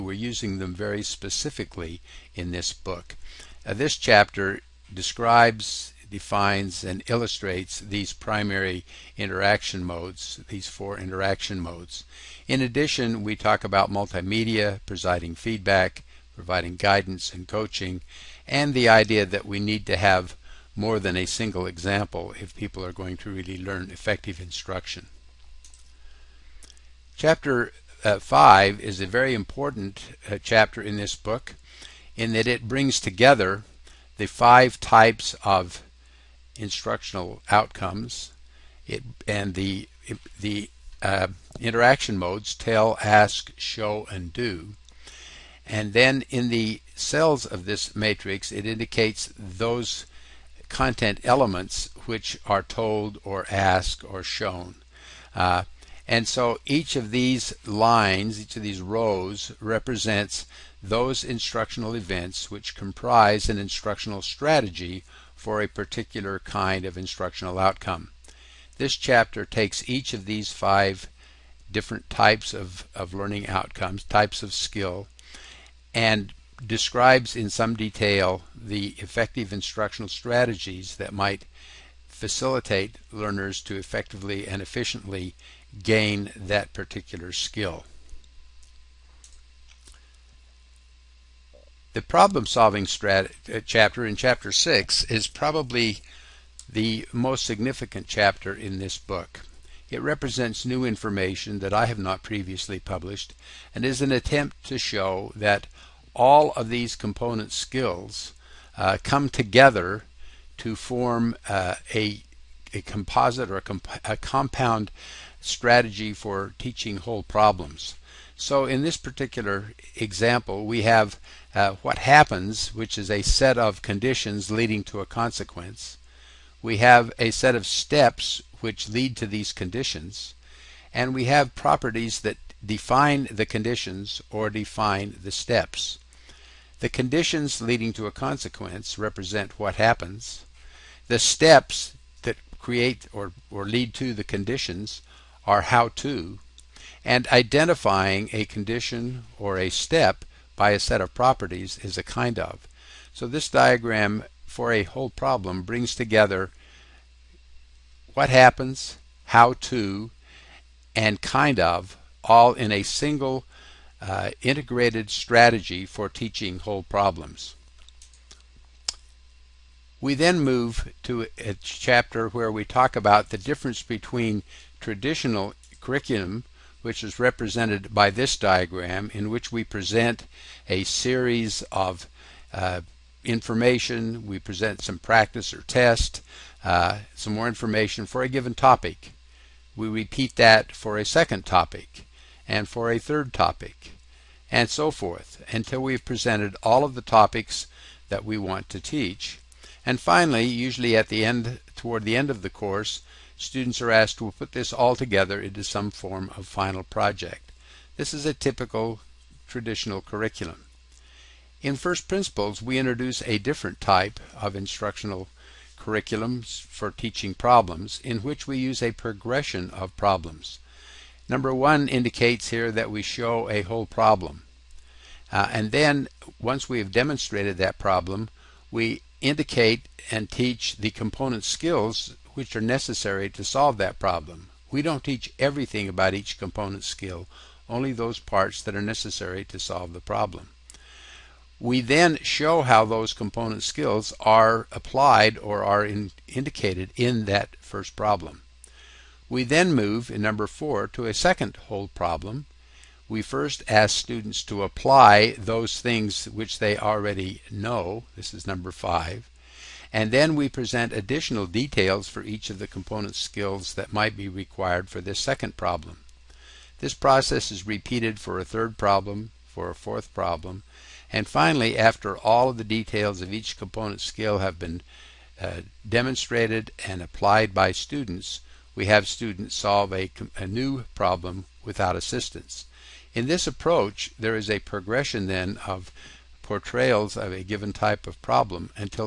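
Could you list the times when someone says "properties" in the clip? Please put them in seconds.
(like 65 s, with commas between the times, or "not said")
131 s, 151 s.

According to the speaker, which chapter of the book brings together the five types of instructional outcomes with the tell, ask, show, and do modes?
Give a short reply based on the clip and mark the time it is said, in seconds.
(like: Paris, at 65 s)
Chapter 5, at 27 s.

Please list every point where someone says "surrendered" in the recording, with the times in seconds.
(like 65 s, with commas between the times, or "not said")
not said.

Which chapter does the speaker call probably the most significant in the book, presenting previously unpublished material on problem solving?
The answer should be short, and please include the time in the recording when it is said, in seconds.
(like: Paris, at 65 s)
Chapter 6, at 94 s.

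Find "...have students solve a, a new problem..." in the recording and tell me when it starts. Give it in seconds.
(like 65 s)
278 s.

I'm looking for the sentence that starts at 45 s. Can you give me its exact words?
And then in the cells of this matrix, it indicates those content elements which are told or asked or shown.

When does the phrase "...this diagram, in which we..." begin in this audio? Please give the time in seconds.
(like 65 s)
178 s.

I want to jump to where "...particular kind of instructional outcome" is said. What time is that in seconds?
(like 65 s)
65 s.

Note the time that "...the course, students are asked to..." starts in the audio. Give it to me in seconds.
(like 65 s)
202 s.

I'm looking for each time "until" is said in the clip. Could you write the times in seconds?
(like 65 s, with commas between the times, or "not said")
195 s.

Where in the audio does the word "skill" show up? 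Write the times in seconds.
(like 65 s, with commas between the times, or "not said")
74 s, 87 s, 107 s, 231 s, 236 s, 243 s, 263 s, 274 s.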